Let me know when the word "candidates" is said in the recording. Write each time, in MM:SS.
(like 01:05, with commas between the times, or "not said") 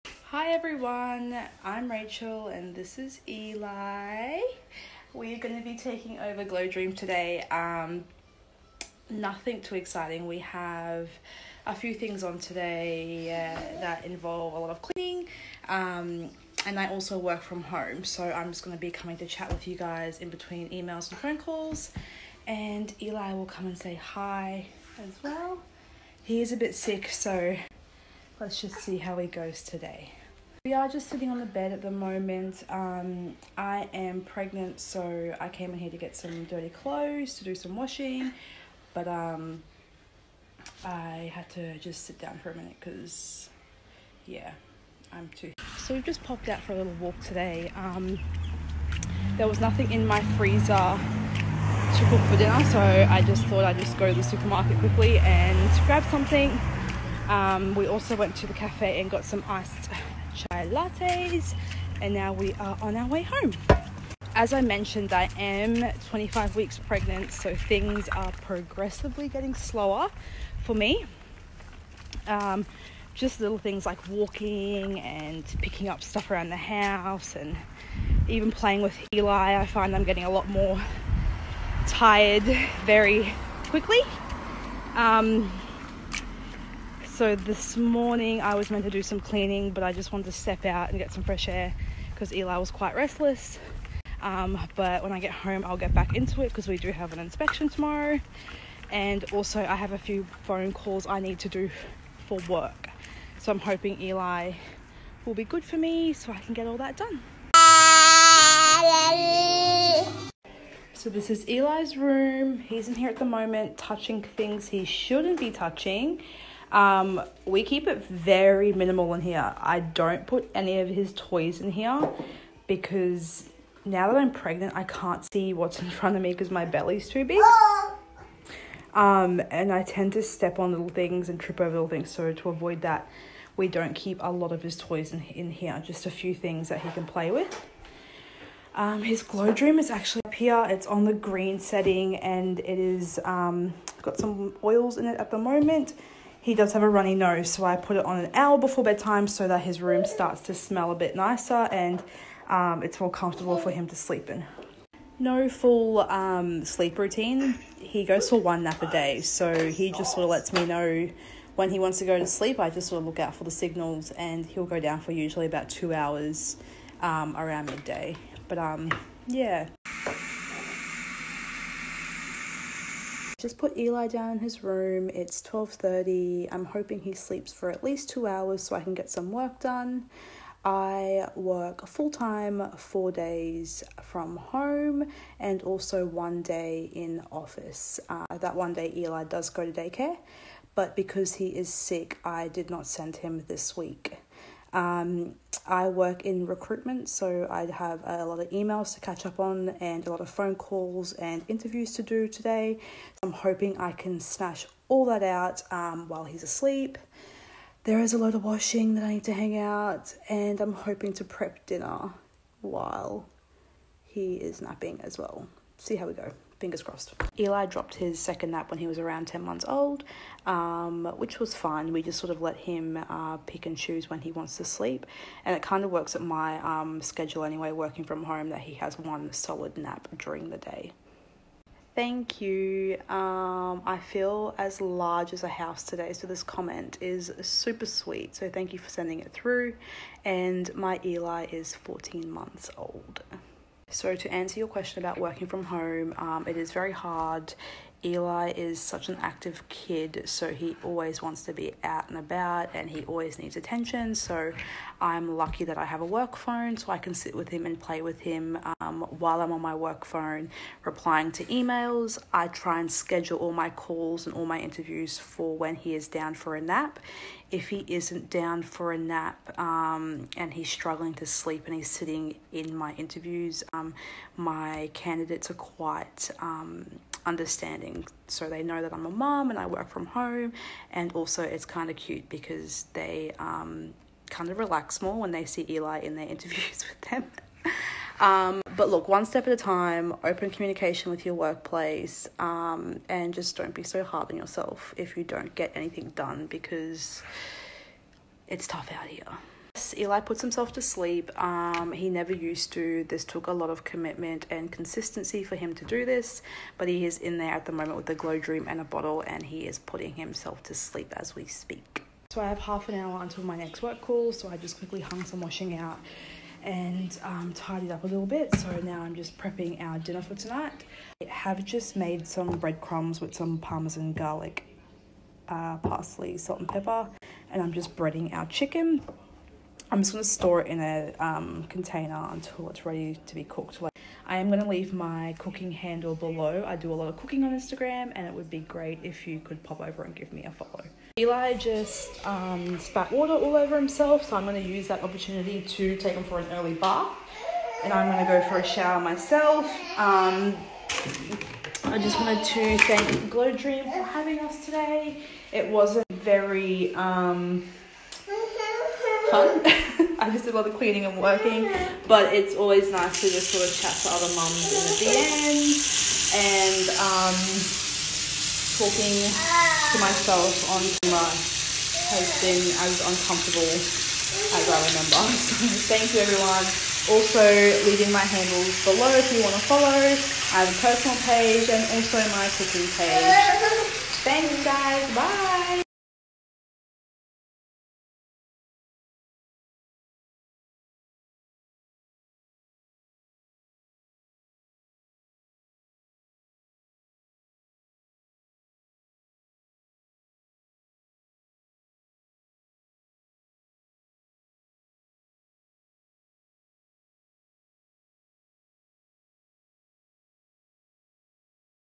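04:34.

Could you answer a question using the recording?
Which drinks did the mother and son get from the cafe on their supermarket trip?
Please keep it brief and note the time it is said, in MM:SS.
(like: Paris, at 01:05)
Iced chai lattes, at 00:59.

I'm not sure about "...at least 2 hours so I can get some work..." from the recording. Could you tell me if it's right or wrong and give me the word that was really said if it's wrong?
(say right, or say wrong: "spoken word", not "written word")
right.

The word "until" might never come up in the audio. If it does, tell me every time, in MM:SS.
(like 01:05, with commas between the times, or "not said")
05:13, 05:32.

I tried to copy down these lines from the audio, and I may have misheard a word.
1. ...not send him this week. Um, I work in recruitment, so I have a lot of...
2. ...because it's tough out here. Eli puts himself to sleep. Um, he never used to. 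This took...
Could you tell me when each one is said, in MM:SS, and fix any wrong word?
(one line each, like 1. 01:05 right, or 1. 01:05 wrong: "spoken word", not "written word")
1. 03:12 right
2. 04:56 right.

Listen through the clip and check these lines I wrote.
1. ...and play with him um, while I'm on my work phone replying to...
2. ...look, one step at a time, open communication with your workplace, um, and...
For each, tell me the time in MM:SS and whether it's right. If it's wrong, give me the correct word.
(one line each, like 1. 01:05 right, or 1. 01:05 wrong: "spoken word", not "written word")
1. 04:17 right
2. 04:48 right.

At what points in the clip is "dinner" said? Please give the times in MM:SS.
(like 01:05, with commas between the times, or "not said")
00:52, 03:31, 05:19.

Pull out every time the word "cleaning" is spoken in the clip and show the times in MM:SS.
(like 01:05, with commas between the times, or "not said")
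00:14, 01:29, 06:00.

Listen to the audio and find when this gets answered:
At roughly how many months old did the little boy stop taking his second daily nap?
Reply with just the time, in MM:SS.
03:39.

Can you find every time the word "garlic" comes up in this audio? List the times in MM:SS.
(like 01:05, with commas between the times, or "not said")
05:24.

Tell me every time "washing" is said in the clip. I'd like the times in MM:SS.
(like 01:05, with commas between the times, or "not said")
00:37, 03:28, 05:15.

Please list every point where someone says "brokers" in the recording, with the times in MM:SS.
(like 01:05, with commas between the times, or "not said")
not said.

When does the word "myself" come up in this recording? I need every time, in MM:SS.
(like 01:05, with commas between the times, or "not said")
05:48, 06:09.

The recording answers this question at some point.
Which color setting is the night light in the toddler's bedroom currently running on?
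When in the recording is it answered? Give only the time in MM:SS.
02:21.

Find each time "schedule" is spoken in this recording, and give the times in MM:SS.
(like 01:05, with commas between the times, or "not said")
03:47, 04:22.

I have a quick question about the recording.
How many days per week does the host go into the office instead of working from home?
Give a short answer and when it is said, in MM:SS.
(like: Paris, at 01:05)
1, at 03:06.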